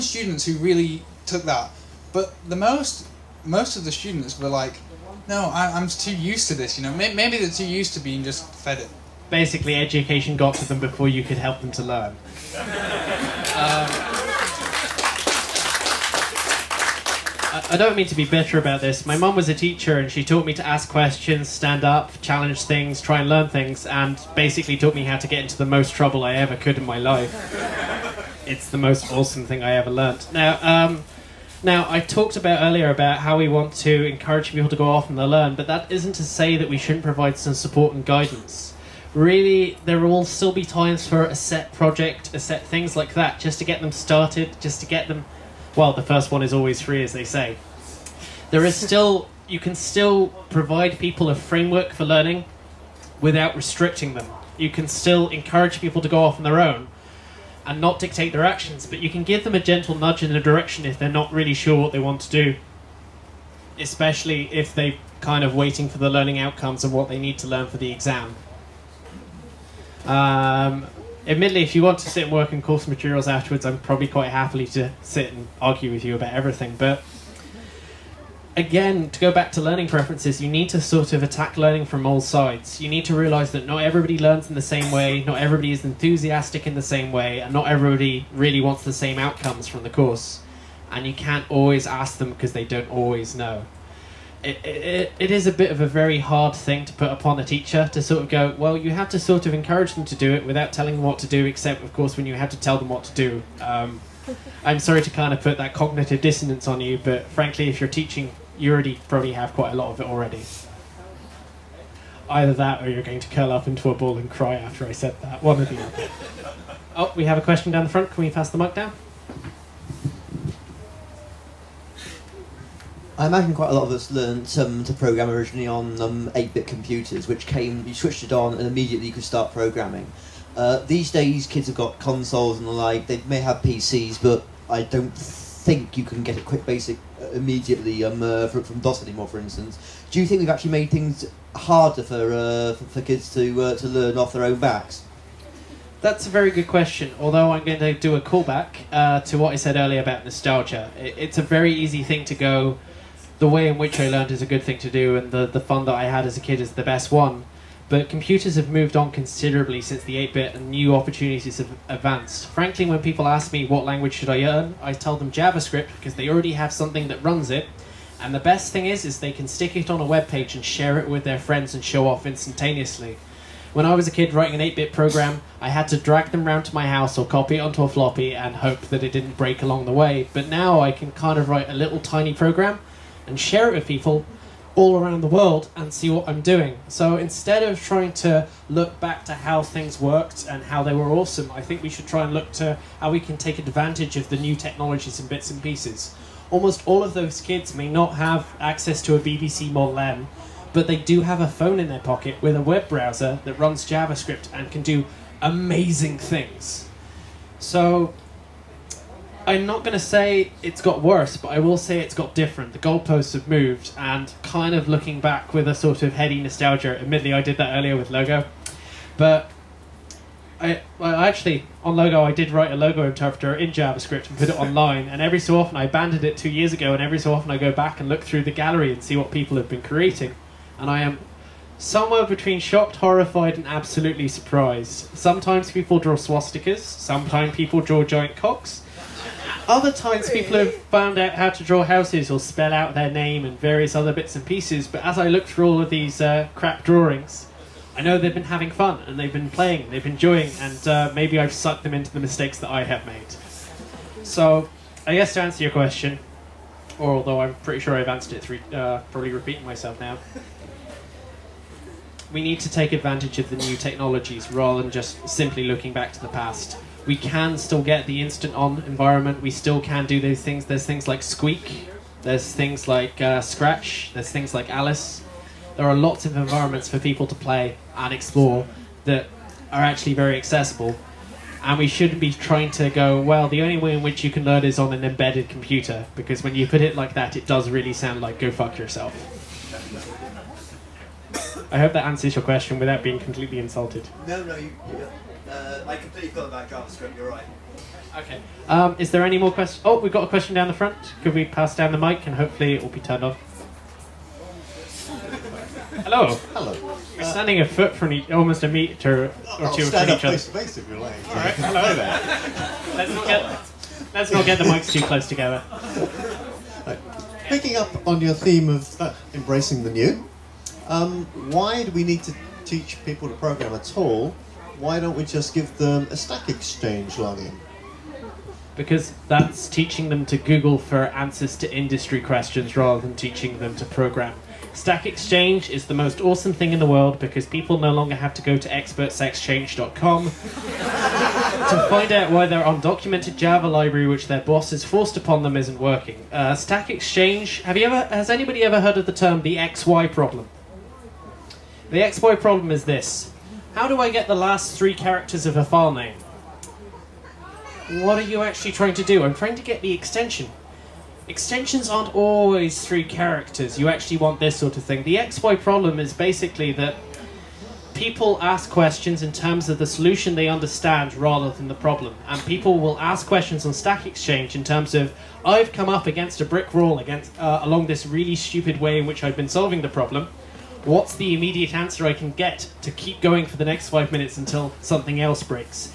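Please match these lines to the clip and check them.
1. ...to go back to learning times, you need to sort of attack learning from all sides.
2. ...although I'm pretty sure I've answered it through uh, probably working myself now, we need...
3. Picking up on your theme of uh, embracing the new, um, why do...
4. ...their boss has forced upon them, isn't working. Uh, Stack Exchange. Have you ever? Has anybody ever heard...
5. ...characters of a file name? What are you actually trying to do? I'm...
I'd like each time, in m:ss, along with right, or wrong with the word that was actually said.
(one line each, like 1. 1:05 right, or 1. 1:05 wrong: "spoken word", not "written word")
1. 1:19 wrong: "preferences", not "times"
2. 4:17 wrong: "repeating", not "working"
3. 5:17 right
4. 5:44 right
5. 5:54 right.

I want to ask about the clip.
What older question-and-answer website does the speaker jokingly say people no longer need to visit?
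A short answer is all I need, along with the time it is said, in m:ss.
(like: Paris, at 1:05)
expertsexchange.com, at 5:38.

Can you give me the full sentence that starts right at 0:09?
Basically, education got to them before you could help them to learn.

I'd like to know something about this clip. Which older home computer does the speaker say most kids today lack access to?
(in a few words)
BBC Model B.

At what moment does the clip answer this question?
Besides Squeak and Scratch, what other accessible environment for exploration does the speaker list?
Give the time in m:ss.
4:34.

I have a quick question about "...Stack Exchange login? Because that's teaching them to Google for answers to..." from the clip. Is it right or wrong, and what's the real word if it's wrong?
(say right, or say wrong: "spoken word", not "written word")
right.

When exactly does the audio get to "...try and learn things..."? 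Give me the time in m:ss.
0:22.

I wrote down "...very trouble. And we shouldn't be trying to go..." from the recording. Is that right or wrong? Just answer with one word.
wrong.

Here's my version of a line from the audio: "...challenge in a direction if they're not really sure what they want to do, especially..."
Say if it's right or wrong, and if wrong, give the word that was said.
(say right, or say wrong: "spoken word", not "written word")
wrong: "nudge", not "challenge".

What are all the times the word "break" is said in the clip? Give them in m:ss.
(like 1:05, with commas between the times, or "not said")
2:59, 6:25.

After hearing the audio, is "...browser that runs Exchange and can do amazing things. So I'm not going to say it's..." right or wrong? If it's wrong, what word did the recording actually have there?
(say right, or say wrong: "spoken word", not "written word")
wrong: "JavaScript", not "Exchange".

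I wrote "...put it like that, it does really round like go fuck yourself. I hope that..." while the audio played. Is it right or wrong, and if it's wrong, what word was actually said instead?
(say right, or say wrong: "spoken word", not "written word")
wrong: "sound", not "round".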